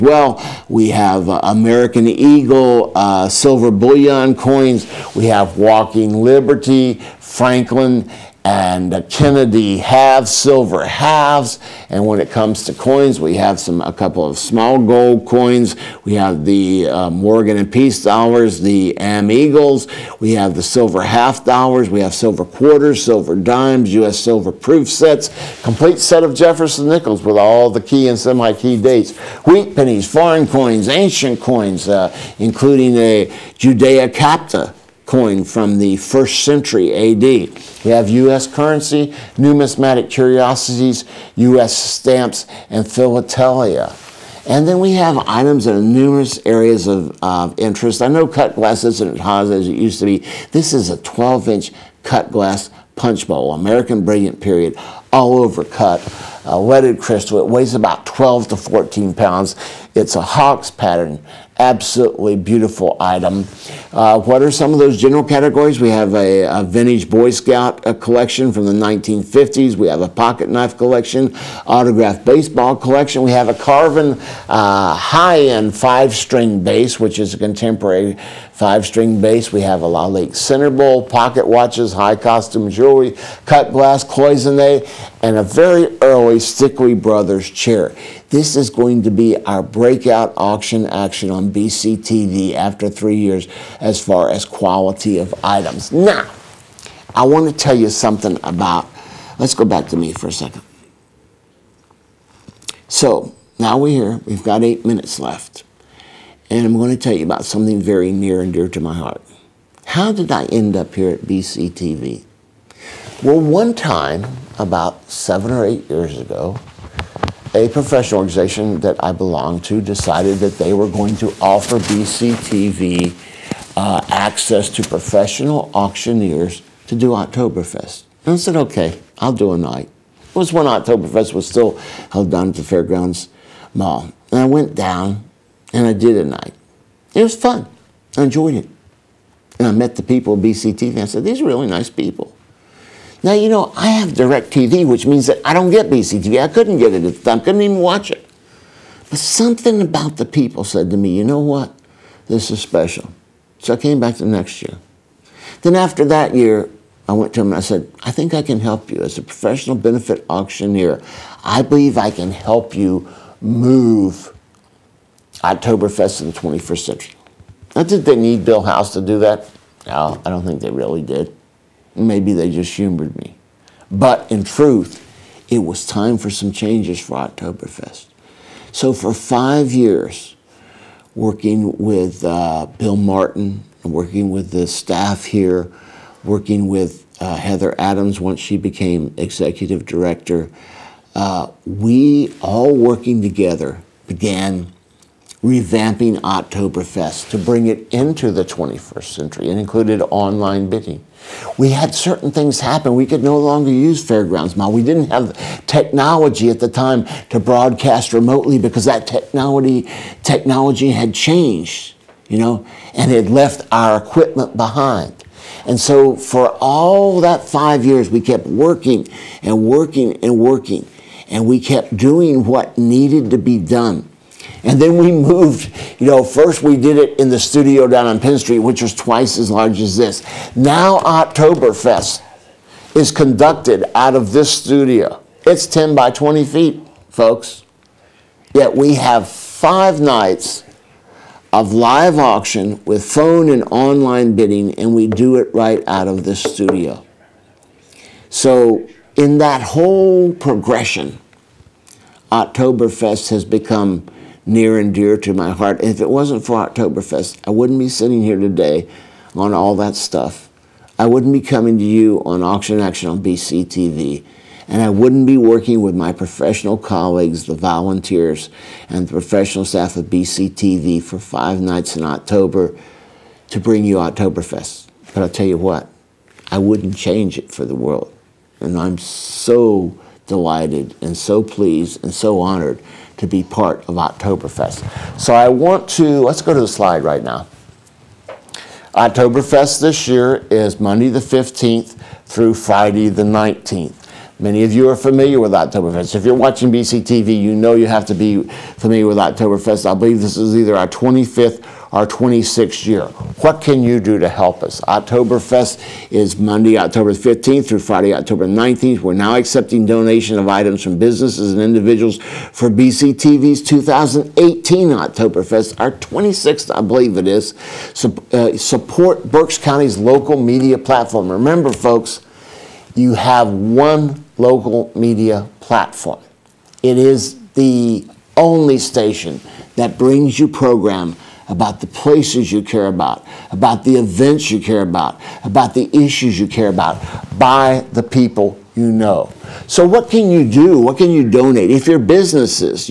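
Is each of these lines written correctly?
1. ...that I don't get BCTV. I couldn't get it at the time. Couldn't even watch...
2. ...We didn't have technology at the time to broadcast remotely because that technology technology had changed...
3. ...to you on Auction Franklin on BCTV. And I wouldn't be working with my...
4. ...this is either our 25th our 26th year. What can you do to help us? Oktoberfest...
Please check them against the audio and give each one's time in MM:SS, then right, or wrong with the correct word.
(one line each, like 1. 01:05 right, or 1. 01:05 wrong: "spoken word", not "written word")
1. 02:25 right
2. 03:24 right
3. 04:21 wrong: "Action", not "Franklin"
4. 05:00 right.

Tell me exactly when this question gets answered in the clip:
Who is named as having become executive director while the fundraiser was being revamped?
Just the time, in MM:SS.
03:07.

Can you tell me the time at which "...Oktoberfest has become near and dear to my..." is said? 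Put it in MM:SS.
04:12.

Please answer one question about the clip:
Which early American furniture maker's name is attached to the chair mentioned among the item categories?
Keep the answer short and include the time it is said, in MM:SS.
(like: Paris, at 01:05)
Stickley Brothers, at 01:26.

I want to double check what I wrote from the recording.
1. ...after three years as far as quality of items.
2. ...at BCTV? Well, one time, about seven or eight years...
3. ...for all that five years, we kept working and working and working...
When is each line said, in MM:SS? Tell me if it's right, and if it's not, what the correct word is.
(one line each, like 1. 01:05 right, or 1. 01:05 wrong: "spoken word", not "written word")
1. 01:32 right
2. 01:51 right
3. 03:36 right.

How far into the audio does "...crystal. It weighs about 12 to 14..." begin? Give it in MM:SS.
00:56.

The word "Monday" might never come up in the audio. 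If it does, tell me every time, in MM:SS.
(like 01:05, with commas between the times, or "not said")
04:50, 05:06.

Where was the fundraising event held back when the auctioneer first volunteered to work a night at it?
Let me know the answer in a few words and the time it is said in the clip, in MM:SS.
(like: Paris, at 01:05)
Fairgrounds Mall, at 02:12.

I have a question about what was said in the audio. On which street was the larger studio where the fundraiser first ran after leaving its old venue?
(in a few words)
Penn Street.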